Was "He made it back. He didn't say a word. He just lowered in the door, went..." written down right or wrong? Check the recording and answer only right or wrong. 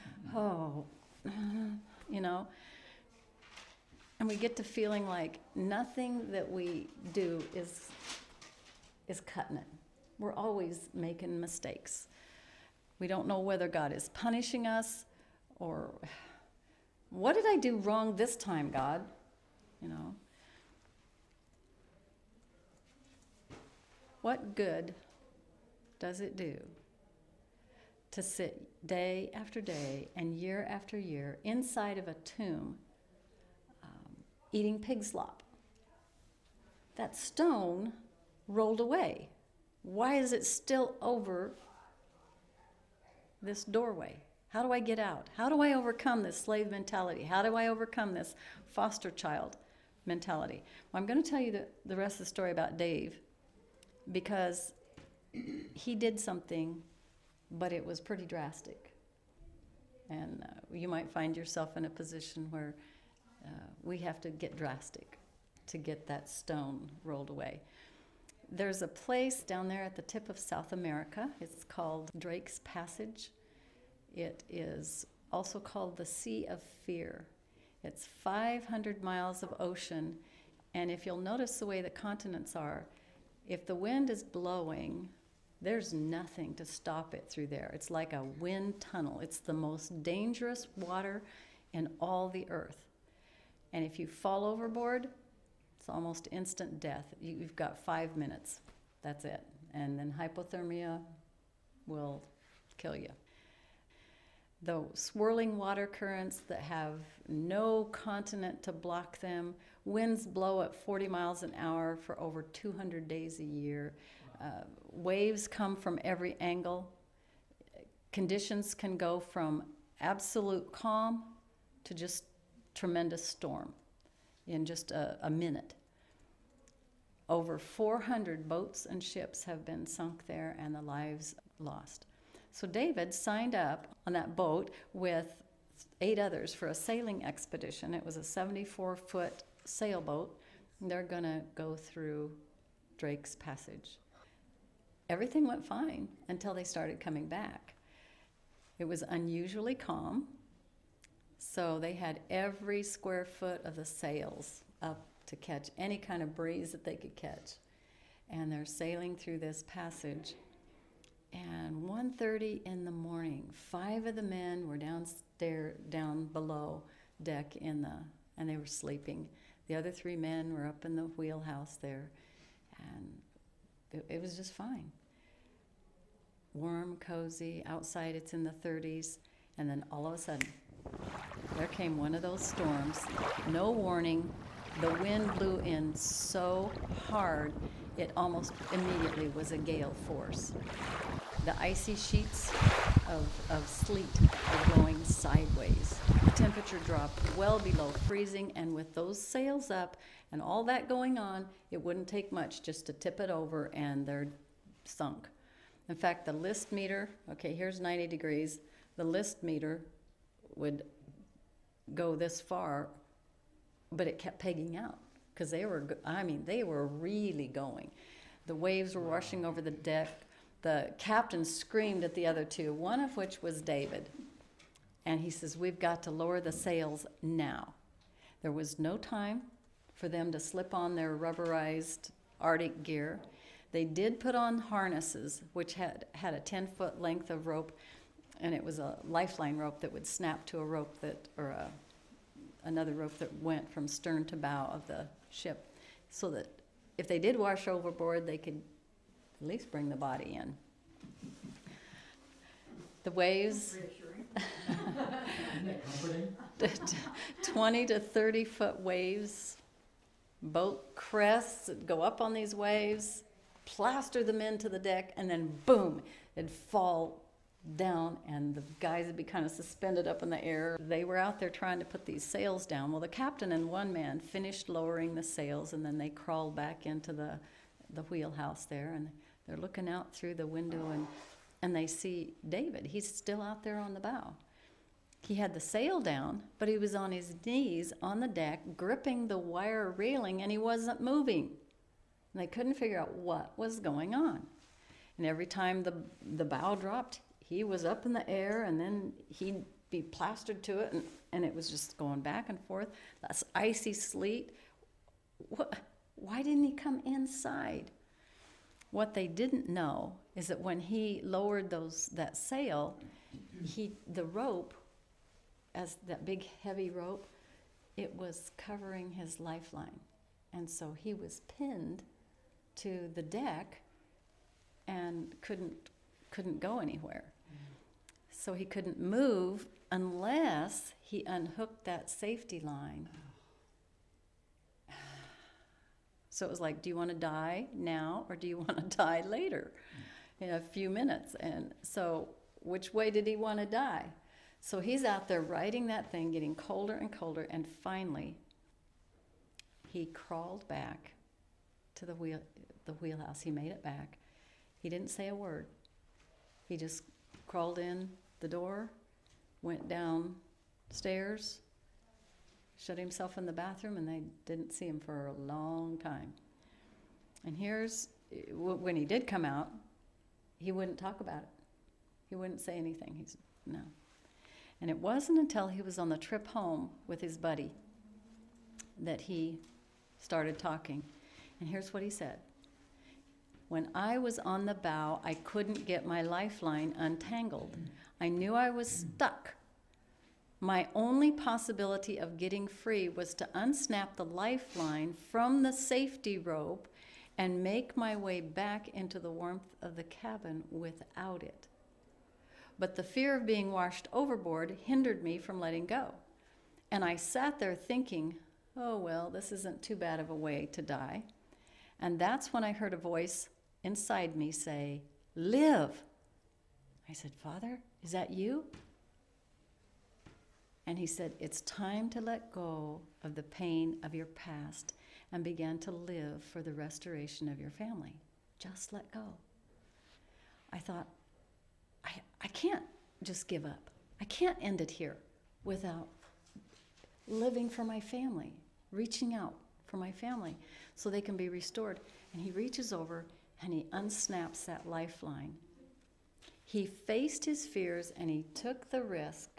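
wrong.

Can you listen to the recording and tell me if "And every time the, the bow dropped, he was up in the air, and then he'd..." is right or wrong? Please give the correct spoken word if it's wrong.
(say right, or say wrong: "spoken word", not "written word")
right.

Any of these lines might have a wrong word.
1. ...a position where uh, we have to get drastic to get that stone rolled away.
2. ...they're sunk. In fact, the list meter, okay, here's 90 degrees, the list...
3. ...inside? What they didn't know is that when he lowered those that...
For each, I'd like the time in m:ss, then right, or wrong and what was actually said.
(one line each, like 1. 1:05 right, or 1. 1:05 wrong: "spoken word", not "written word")
1. 1:01 right
2. 3:24 right
3. 5:07 right.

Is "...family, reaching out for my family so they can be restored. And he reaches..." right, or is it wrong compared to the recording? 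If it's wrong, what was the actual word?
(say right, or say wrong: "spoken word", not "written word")
right.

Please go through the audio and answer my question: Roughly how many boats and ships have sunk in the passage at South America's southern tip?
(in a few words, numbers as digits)
Over 400.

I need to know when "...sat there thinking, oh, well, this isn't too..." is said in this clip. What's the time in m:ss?
6:47.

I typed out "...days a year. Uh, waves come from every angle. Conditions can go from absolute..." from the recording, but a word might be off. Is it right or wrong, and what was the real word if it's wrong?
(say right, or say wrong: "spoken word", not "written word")
right.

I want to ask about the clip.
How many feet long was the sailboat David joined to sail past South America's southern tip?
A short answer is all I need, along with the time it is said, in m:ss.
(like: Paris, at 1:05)
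74 foot, at 2:18.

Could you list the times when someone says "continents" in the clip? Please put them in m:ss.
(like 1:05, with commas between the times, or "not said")
1:21, 1:47.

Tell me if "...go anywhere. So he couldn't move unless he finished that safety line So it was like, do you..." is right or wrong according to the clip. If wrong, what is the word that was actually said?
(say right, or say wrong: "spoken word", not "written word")
wrong: "unhooked", not "finished".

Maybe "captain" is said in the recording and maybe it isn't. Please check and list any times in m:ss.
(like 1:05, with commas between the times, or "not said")
3:40, 4:33.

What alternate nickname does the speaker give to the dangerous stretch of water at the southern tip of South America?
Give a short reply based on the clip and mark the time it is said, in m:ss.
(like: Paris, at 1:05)
Sea of Fear, at 1:16.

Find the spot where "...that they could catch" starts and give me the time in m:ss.
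2:36.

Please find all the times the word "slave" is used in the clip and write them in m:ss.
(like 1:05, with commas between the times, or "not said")
0:46.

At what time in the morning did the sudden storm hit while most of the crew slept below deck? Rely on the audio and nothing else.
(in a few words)
1:30.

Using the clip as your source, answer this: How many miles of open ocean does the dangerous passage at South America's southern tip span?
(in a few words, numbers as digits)
500 miles.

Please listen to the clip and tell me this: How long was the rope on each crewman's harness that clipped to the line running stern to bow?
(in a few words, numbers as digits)
10 foot.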